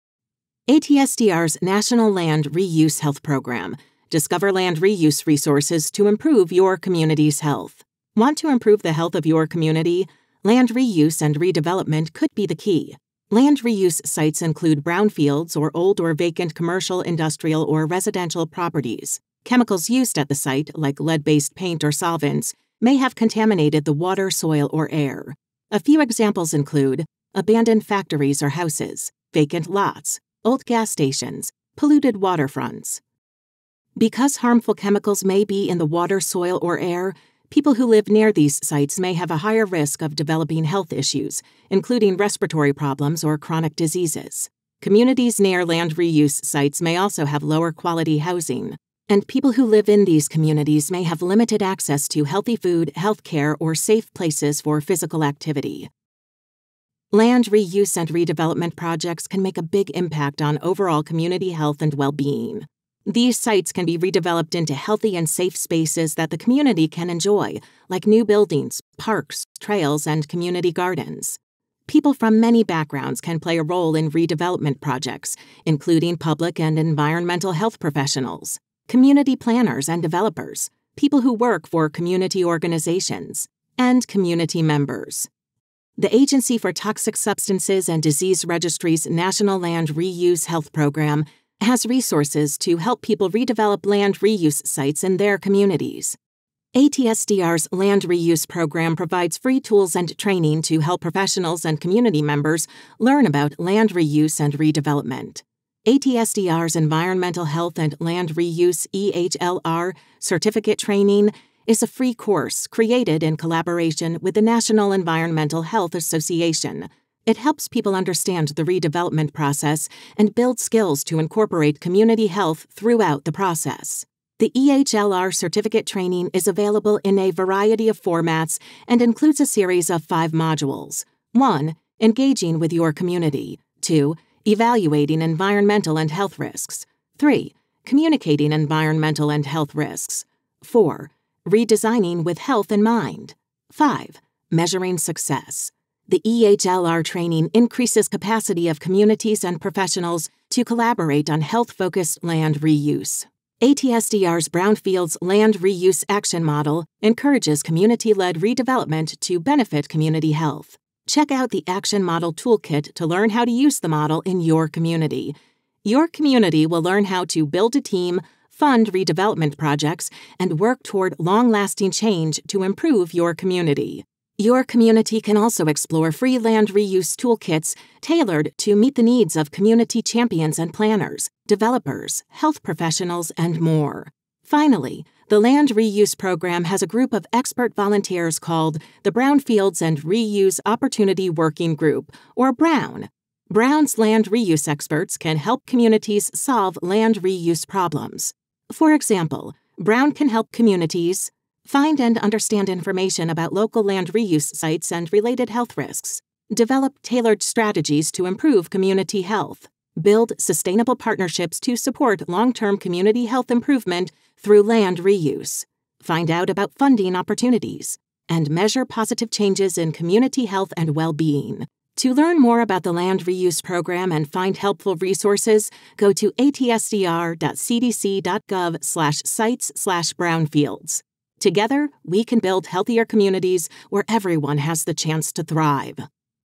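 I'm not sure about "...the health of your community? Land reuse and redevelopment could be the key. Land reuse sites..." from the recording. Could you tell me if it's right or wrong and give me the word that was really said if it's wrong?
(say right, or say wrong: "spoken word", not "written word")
right.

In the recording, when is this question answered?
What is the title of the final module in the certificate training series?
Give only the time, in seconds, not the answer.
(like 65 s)
144 s.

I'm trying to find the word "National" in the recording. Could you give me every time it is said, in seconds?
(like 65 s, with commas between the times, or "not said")
1 s, 89 s, 114 s.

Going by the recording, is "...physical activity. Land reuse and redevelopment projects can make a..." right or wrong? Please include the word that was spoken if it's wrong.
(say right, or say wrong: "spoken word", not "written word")
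right.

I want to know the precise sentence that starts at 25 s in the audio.
A few examples include abandoned factories or houses, vacant lots, old gas stations, polluted waterfronts.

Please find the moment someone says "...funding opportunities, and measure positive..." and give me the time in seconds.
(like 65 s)
216 s.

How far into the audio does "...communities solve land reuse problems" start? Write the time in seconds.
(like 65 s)
195 s.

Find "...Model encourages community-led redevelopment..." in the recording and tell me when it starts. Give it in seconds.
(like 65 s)
156 s.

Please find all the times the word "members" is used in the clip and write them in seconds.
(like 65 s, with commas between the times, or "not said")
84 s, 102 s.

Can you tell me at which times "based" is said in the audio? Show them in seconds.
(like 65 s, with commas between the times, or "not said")
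21 s.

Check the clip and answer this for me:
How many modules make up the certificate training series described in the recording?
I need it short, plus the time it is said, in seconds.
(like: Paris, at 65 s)
5, at 130 s.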